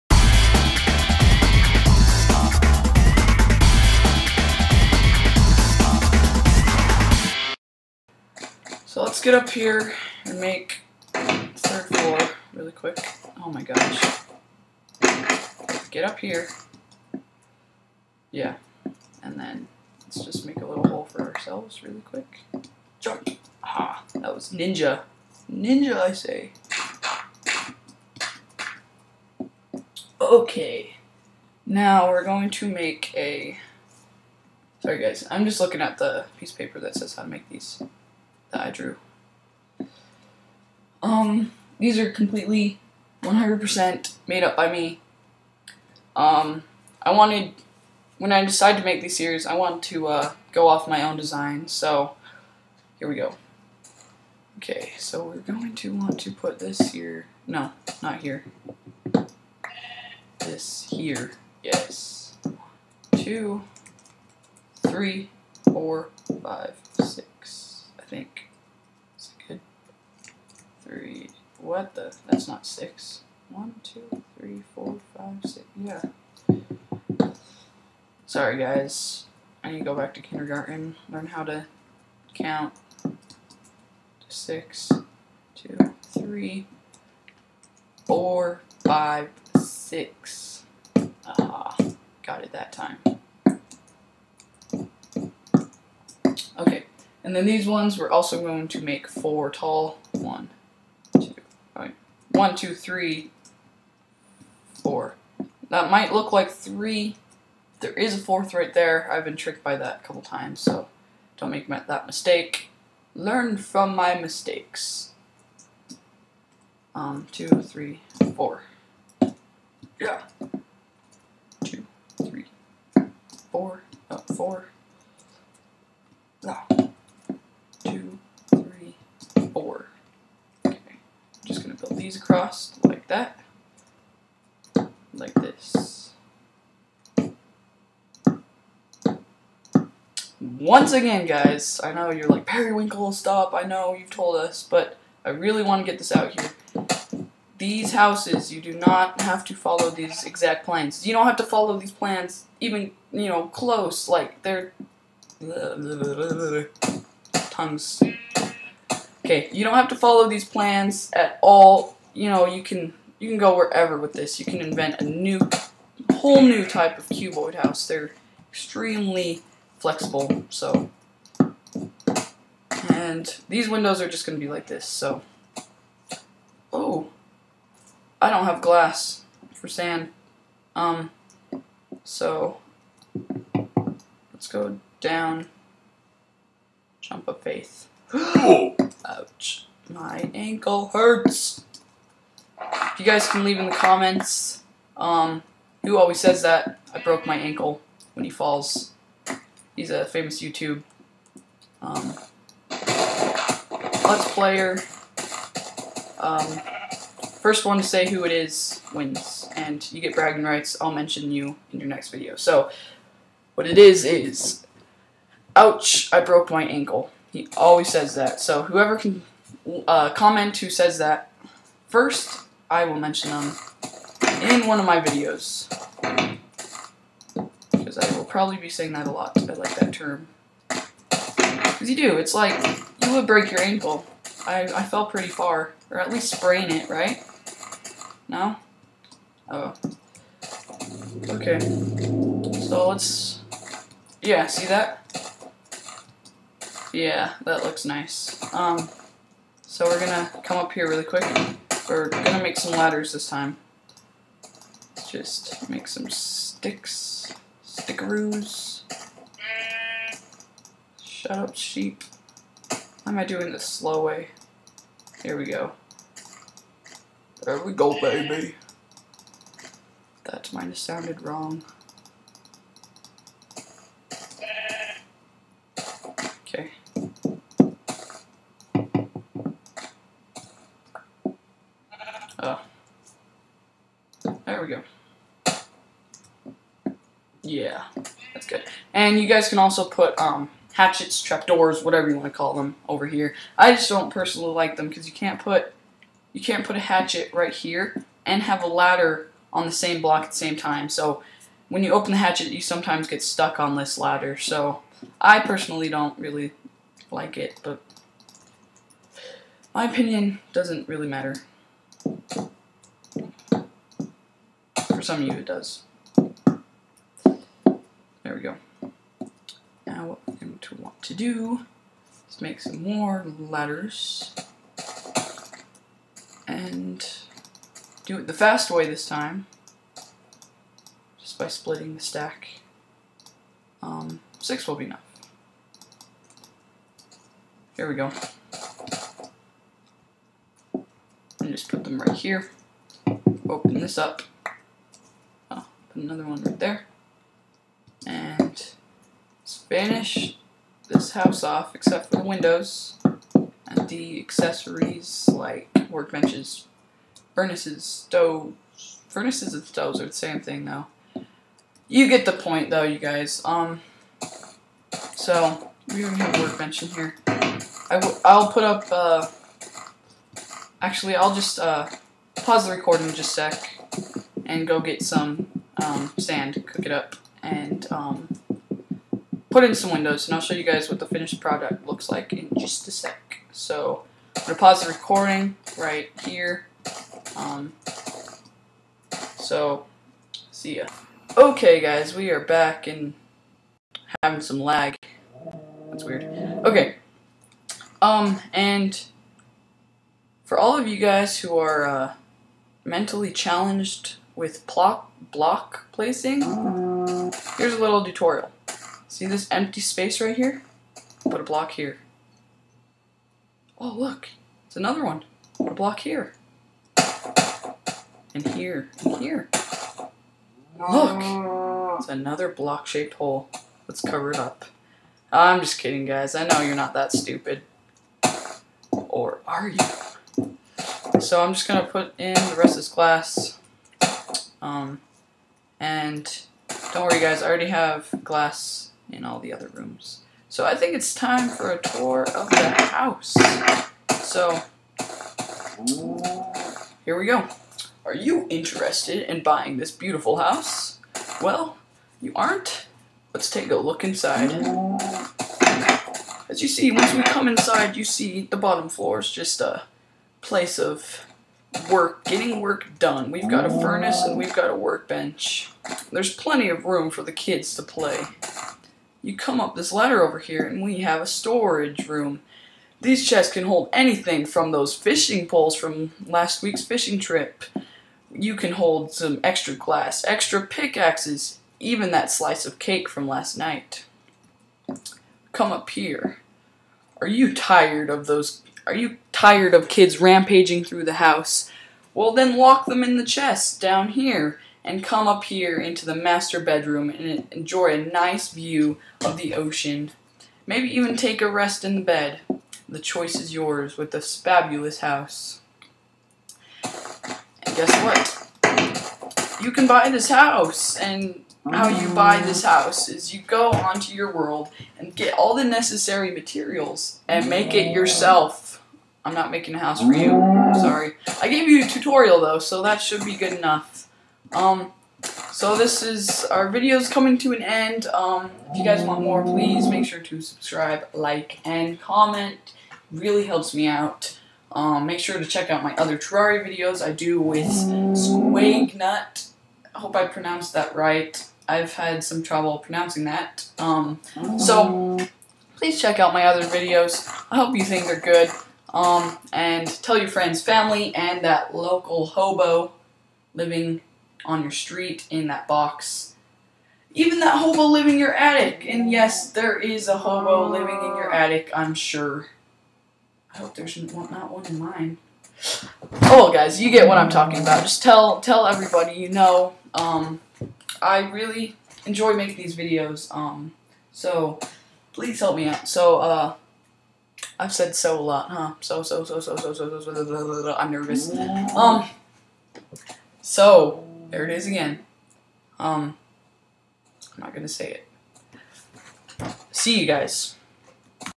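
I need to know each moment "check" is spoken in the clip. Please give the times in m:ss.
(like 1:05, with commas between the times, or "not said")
8:55, 9:06.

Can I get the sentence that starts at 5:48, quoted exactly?
And finish this house off, except for the windows and the accessories like workbenches, furnaces, stoves.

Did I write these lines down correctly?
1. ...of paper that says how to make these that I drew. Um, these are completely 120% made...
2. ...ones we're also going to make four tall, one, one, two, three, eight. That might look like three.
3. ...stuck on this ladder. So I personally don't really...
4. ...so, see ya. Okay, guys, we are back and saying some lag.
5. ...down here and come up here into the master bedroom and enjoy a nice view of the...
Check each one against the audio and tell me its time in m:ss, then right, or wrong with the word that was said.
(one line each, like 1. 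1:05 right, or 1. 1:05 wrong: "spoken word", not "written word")
1. 0:36 wrong: "100", not "120"
2. 1:37 wrong: "four", not "eight"
3. 5:03 right
4. 6:29 wrong: "having", not "saying"
5. 8:13 right.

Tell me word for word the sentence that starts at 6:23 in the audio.
So I'm going to pause the recording right here.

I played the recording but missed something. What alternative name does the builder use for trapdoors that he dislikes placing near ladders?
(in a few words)
hatchets.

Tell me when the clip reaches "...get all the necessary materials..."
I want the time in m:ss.
8:35.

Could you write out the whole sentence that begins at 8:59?
I hope I pronounced that right.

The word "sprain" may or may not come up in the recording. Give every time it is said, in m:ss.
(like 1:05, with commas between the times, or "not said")
3:56.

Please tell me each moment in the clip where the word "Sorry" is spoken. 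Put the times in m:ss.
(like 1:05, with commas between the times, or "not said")
0:34, 1:18, 8:40.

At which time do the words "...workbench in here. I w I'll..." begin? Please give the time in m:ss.
6:06.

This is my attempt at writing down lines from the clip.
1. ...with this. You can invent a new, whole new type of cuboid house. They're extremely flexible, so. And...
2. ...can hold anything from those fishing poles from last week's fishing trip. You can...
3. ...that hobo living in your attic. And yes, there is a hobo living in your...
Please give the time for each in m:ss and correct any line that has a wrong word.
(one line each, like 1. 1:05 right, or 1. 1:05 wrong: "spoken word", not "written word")
1. 2:43 right
2. 7:53 right
3. 9:17 right.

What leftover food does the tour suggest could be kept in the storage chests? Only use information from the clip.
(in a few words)
slice of cake.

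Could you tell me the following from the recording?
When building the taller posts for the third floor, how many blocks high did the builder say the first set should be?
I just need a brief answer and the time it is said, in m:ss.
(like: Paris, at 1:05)
6, at 1:07.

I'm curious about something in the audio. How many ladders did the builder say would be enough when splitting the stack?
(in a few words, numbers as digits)
6.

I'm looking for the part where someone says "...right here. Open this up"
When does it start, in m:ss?
5:41.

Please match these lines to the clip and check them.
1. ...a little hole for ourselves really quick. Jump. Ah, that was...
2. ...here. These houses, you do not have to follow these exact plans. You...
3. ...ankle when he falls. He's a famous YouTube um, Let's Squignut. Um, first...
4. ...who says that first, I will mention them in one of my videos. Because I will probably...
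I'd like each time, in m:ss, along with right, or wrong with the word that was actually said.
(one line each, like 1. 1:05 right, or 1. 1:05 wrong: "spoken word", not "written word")
1. 0:20 right
2. 2:26 right
3. 3:17 wrong: "Player", not "Squignut"
4. 3:40 right.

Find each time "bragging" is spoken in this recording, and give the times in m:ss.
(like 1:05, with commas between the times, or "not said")
3:30.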